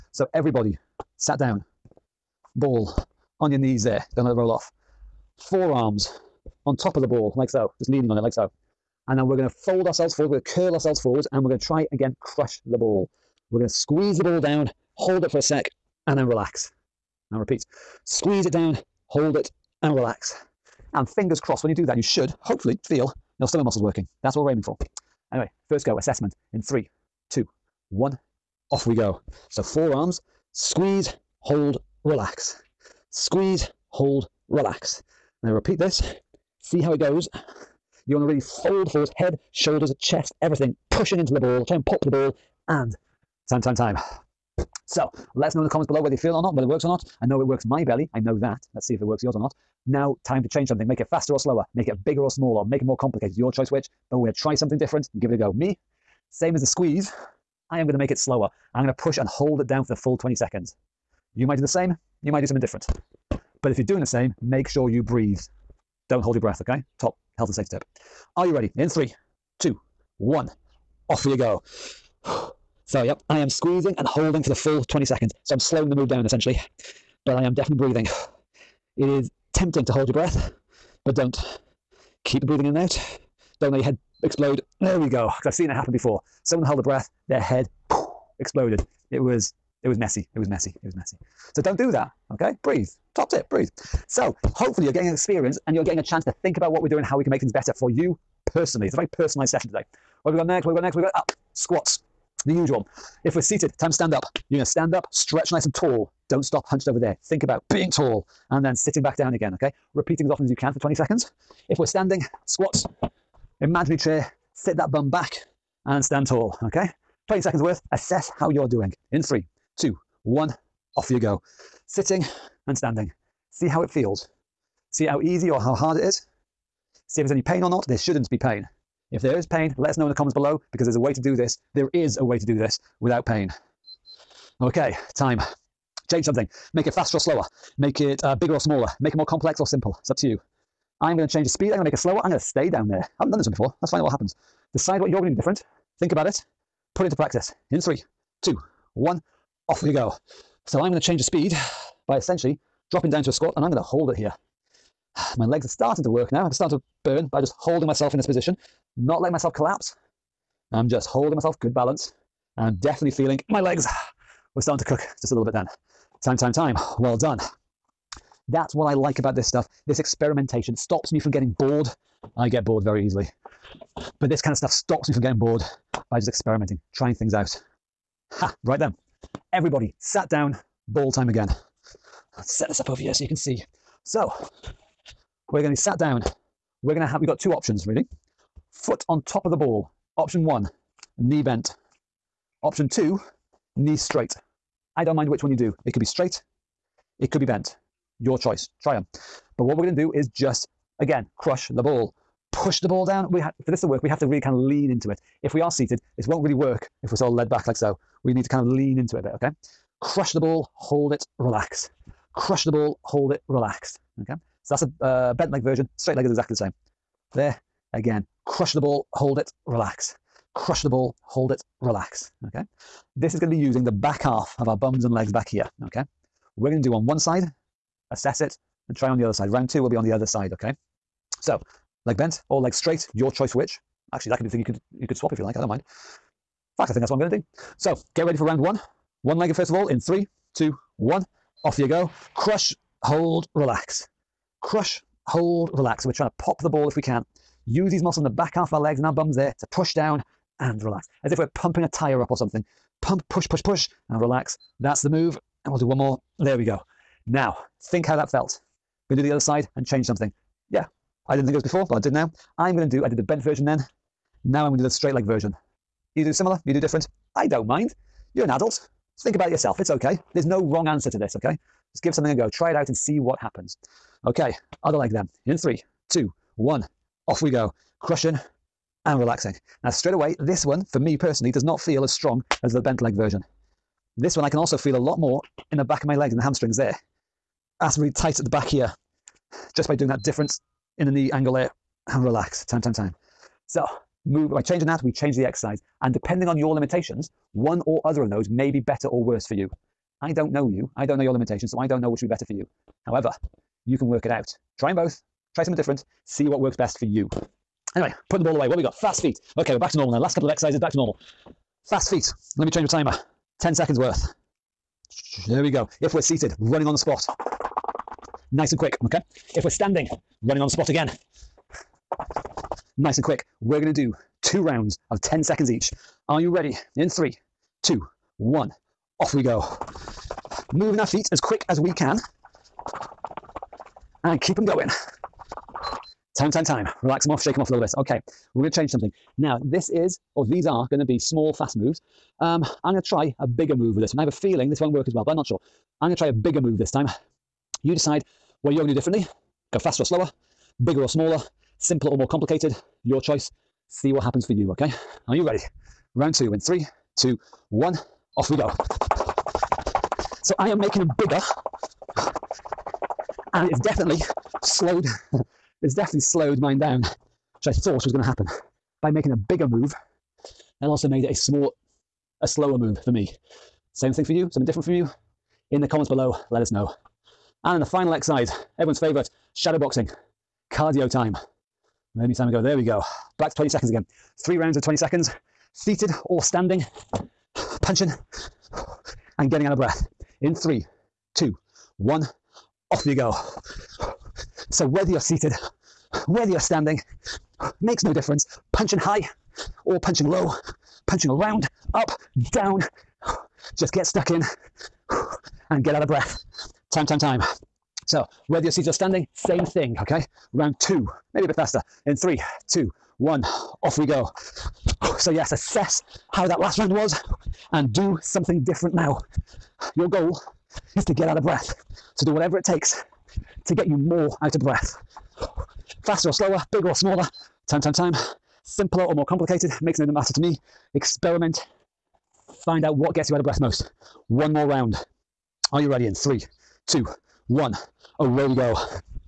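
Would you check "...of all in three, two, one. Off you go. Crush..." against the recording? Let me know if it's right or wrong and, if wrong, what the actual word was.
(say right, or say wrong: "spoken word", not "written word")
right.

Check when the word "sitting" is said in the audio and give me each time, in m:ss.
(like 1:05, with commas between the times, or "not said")
1:48, 2:01.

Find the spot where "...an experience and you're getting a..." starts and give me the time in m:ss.
1:35.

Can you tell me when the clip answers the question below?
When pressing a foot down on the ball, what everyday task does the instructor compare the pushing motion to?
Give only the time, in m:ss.
4:11.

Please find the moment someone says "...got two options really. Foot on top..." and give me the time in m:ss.
3:07.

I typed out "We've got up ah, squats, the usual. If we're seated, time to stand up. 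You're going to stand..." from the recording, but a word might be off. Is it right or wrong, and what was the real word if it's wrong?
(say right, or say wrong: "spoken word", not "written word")
right.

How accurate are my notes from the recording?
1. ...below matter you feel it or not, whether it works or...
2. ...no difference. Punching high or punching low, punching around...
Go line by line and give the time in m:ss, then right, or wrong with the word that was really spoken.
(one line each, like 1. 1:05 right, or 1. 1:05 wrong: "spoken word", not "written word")
1. 0:45 wrong: "whether", not "matter"
2. 6:38 right.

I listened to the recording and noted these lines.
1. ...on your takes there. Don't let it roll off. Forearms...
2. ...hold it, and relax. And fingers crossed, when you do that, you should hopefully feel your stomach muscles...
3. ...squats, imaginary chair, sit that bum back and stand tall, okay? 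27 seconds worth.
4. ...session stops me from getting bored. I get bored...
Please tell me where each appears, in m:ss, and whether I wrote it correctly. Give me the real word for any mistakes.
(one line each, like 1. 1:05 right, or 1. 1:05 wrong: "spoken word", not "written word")
1. 0:03 wrong: "knees", not "takes"
2. 0:19 right
3. 1:52 wrong: "20", not "27"
4. 2:49 wrong: "experimentation", not "session".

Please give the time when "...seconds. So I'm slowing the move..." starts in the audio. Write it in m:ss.
1:15.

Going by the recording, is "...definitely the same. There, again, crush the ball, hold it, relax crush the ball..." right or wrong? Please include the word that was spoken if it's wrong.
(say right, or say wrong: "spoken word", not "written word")
wrong: "exactly", not "definitely".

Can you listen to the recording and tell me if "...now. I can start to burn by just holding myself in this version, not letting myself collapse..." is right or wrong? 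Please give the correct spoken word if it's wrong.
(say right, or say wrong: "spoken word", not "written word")
wrong: "position", not "version".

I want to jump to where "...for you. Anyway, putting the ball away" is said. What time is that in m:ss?
5:06.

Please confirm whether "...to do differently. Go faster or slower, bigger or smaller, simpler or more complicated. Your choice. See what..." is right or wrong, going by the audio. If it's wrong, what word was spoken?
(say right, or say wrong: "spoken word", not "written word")
right.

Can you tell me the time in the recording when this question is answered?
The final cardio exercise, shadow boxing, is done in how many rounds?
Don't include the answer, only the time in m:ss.
6:24.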